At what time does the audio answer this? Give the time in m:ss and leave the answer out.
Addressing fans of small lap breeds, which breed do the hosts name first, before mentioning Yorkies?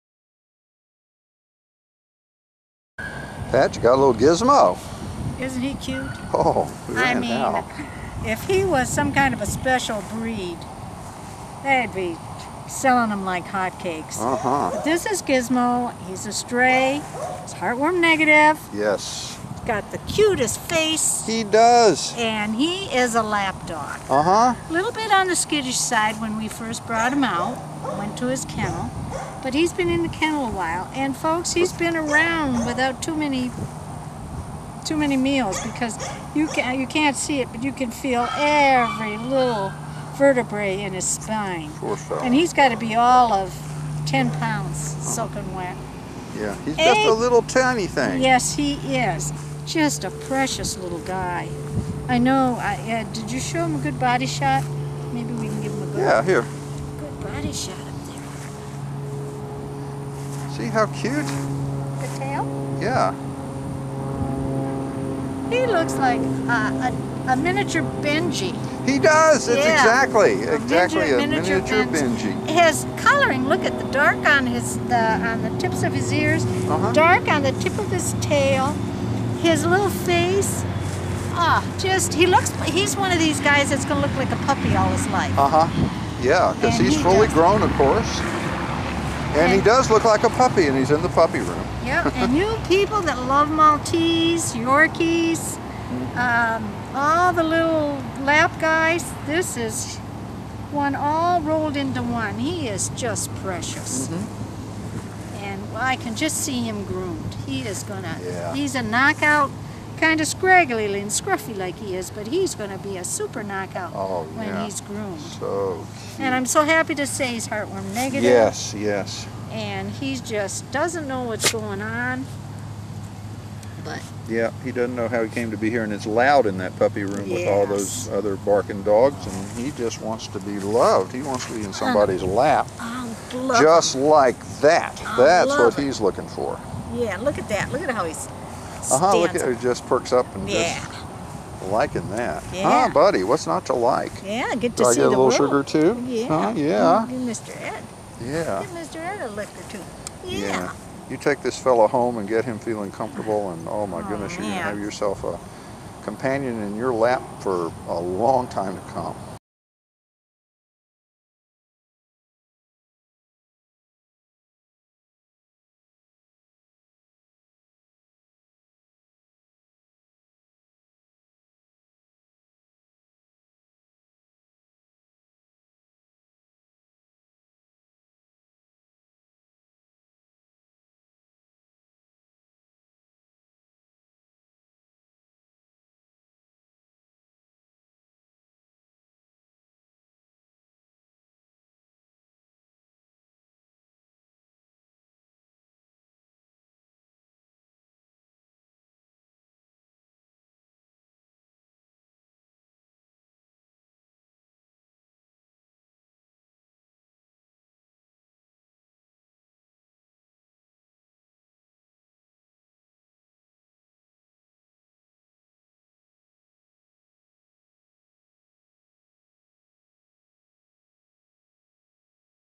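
1:33.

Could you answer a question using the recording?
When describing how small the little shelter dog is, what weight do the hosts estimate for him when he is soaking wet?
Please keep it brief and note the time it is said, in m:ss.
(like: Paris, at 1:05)
10 pounds, at 0:44.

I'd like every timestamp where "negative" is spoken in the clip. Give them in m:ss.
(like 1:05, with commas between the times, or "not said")
0:17, 1:57.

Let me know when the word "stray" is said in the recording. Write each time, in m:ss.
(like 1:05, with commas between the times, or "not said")
0:16.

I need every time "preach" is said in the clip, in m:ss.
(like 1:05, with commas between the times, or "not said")
not said.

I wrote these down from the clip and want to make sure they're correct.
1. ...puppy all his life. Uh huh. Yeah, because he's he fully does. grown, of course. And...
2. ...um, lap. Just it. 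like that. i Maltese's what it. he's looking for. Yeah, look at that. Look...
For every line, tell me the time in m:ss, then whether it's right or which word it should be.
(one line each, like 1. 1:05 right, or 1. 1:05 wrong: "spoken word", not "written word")
1. 1:24 right
2. 2:12 wrong: "That", not "Maltese".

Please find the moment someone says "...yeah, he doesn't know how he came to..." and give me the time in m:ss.
2:04.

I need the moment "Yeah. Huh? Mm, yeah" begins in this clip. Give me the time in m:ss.
2:26.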